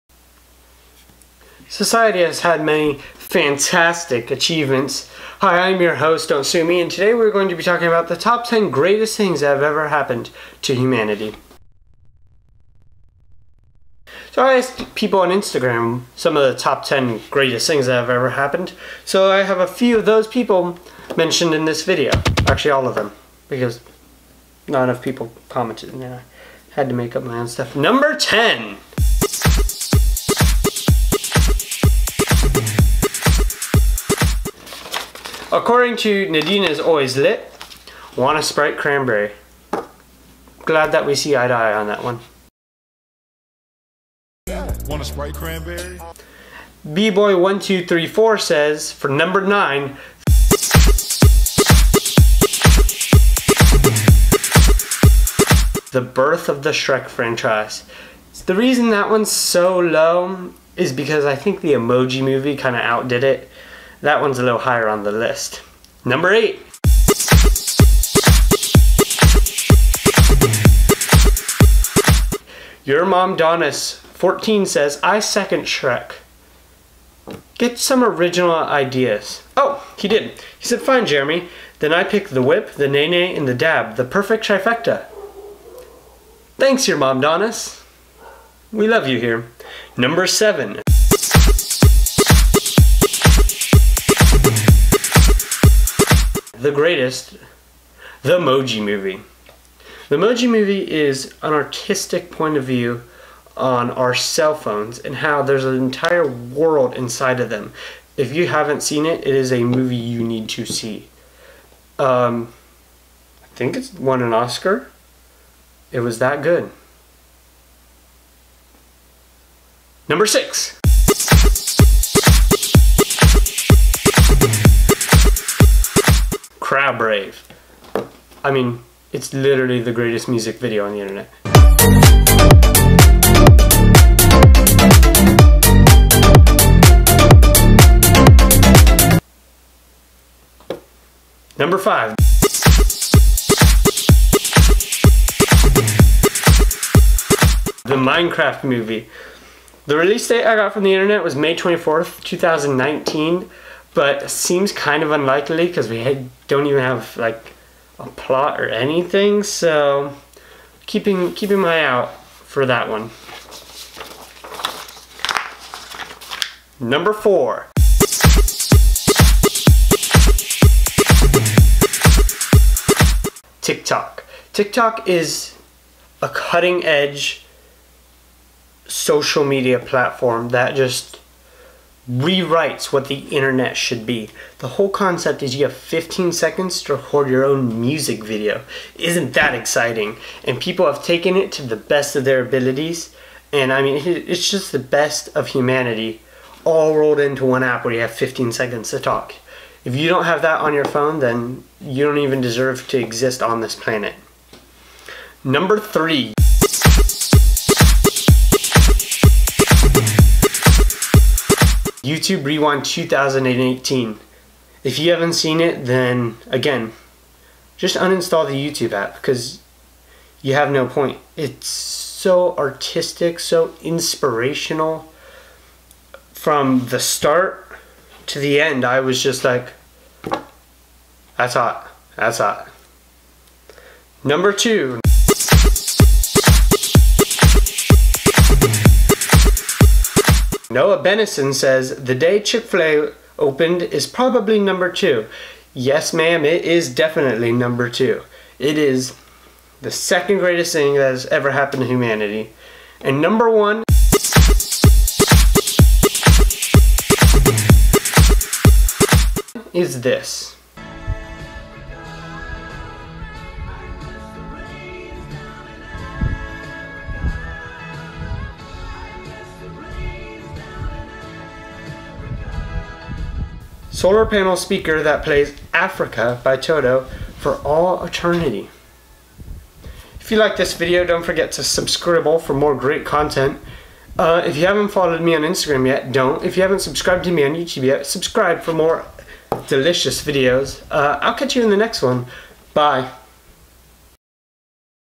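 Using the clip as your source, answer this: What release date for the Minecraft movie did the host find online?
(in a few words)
May 24th, 2019.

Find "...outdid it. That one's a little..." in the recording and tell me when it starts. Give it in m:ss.
1:02.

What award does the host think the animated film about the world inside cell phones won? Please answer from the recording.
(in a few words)
An Oscar.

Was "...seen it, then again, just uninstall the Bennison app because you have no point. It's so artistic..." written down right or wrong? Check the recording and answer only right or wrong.
wrong.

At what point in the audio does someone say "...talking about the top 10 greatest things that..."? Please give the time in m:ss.
0:07.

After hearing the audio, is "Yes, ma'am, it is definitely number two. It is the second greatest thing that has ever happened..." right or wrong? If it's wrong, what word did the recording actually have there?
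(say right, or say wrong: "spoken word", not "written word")
right.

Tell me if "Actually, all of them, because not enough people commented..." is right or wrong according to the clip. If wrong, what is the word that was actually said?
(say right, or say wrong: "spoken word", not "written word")
right.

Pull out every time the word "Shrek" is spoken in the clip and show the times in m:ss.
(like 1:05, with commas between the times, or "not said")
0:56, 1:15.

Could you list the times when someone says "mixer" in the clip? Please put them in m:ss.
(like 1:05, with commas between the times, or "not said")
not said.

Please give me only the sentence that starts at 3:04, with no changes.
The whole concept is you have 15 seconds to record your own music video.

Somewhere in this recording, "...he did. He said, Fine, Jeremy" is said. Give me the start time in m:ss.
1:19.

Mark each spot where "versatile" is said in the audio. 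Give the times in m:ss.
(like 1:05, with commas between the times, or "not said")
not said.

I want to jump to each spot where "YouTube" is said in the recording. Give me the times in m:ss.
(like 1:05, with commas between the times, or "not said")
3:32, 3:38, 4:47.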